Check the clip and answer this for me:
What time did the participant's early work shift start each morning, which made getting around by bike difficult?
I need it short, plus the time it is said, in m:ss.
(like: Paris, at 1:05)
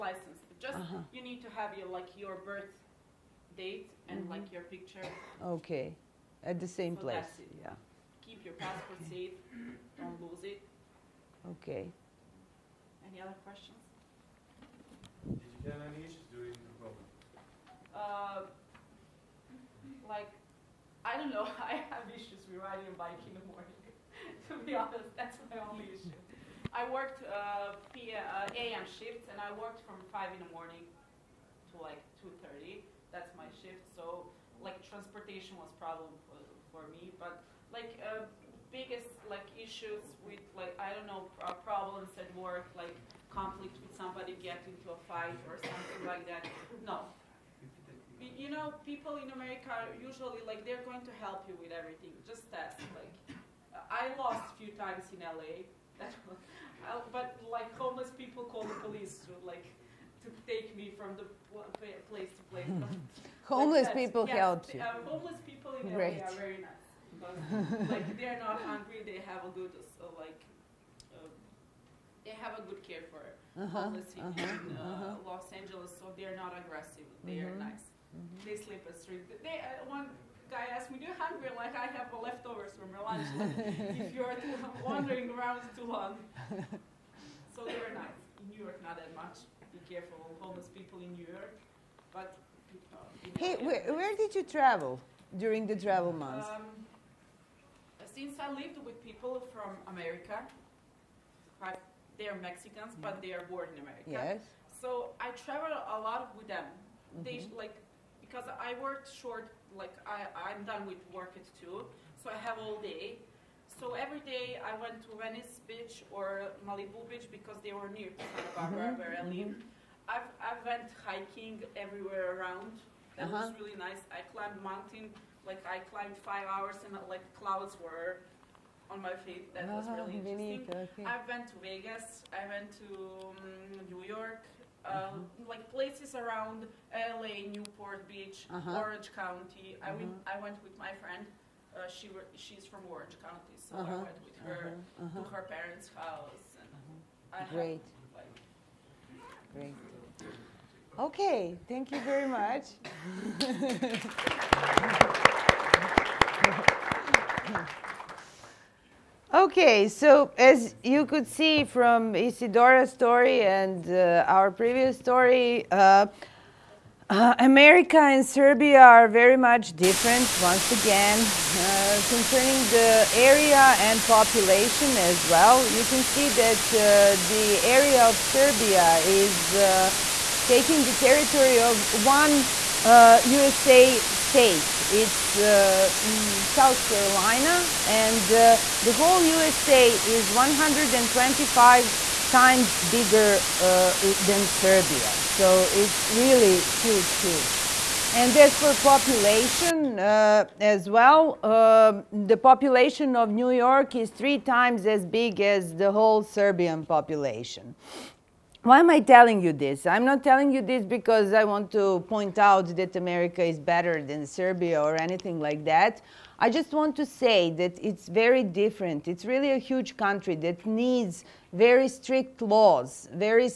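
5 in the morning, at 0:30.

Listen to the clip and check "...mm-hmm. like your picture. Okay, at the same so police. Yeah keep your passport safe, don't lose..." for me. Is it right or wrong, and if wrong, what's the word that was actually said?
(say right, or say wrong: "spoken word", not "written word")
wrong: "place", not "police".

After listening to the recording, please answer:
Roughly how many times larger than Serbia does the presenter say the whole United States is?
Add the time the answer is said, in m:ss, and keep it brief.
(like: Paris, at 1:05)
125, at 3:10.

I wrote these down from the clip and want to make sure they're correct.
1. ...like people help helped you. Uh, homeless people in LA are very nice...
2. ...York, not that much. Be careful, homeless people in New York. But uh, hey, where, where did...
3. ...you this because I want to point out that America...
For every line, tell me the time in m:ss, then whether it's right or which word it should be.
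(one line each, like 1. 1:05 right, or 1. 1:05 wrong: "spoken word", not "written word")
1. 1:03 right
2. 1:28 right
3. 3:30 right.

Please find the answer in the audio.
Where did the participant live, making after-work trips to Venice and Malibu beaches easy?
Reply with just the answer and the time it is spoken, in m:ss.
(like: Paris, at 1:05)
Santa Barbara, at 1:58.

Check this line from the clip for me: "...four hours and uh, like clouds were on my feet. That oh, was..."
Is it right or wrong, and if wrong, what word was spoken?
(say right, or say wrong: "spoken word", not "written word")
wrong: "five", not "four".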